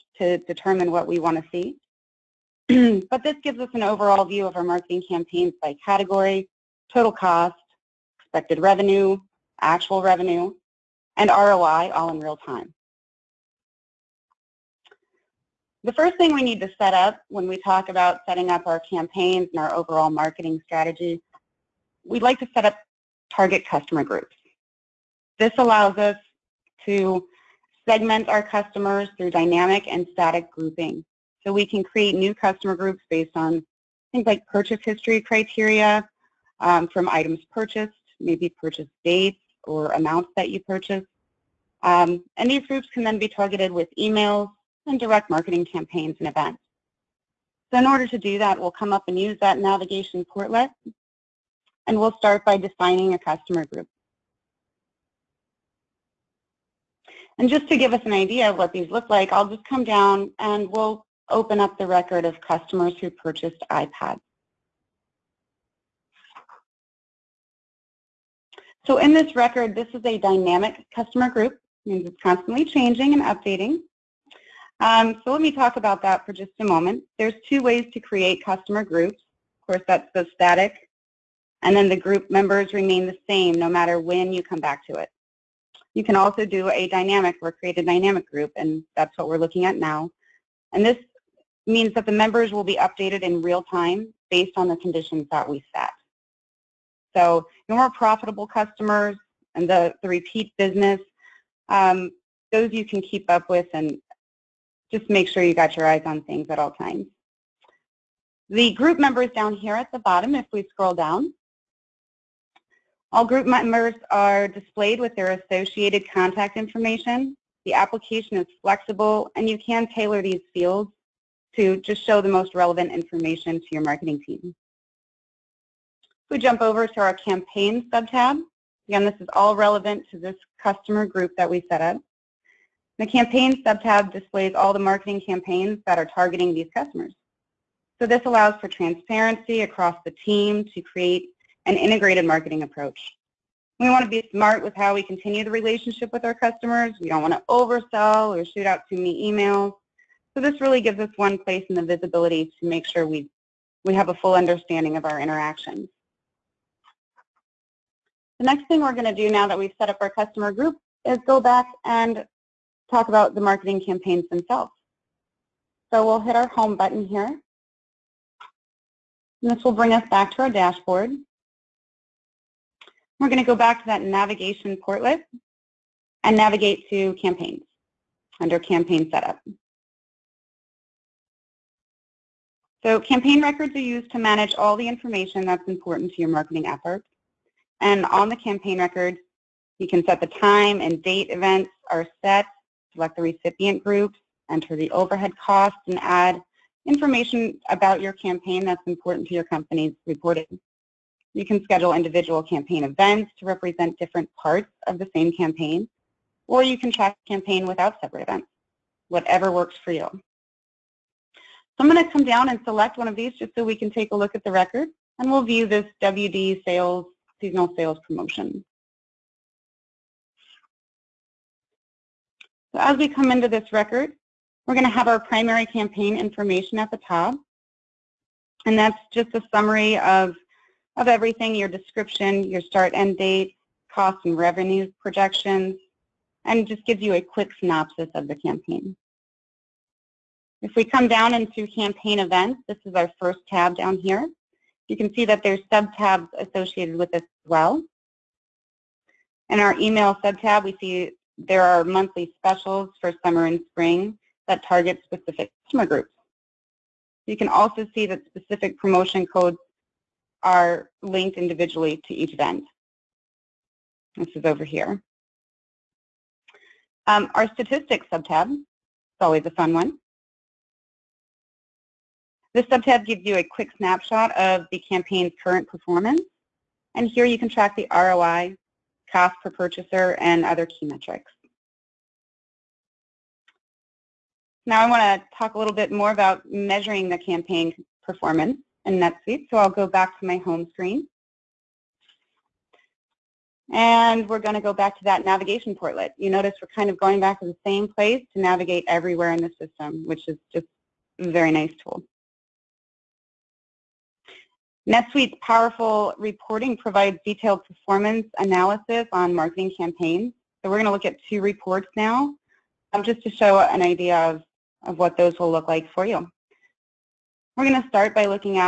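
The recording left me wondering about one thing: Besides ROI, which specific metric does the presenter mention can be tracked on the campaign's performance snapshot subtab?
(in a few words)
cost per purchaser.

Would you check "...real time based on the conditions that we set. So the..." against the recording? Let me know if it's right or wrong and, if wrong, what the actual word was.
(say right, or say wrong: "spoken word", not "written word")
right.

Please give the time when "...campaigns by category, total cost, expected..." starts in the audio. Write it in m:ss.
0:05.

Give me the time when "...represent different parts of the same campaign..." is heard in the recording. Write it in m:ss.
3:23.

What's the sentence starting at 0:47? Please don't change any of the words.
So in order to do that, we'll come up and use that navigation portlet, and we'll start by defining a customer group.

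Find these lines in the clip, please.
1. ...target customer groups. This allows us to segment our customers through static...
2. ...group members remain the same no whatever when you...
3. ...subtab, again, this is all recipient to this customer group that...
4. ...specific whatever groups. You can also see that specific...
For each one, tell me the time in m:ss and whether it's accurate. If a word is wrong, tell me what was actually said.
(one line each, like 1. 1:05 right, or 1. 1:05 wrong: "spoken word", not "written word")
1. 0:23 wrong: "dynamic", not "static"
2. 1:21 wrong: "matter", not "whatever"
3. 2:07 wrong: "relevant", not "recipient"
4. 4:15 wrong: "customer", not "whatever".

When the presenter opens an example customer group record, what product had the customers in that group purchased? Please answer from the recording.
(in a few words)
iPads.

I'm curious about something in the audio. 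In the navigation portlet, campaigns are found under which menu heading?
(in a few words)
campaign setup.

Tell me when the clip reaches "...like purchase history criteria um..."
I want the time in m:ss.
0:34.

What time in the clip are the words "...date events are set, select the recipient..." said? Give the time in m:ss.
3:11.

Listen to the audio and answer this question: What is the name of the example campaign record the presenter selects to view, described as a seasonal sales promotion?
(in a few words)
WD sales.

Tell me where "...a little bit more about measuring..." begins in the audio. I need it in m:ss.
4:45.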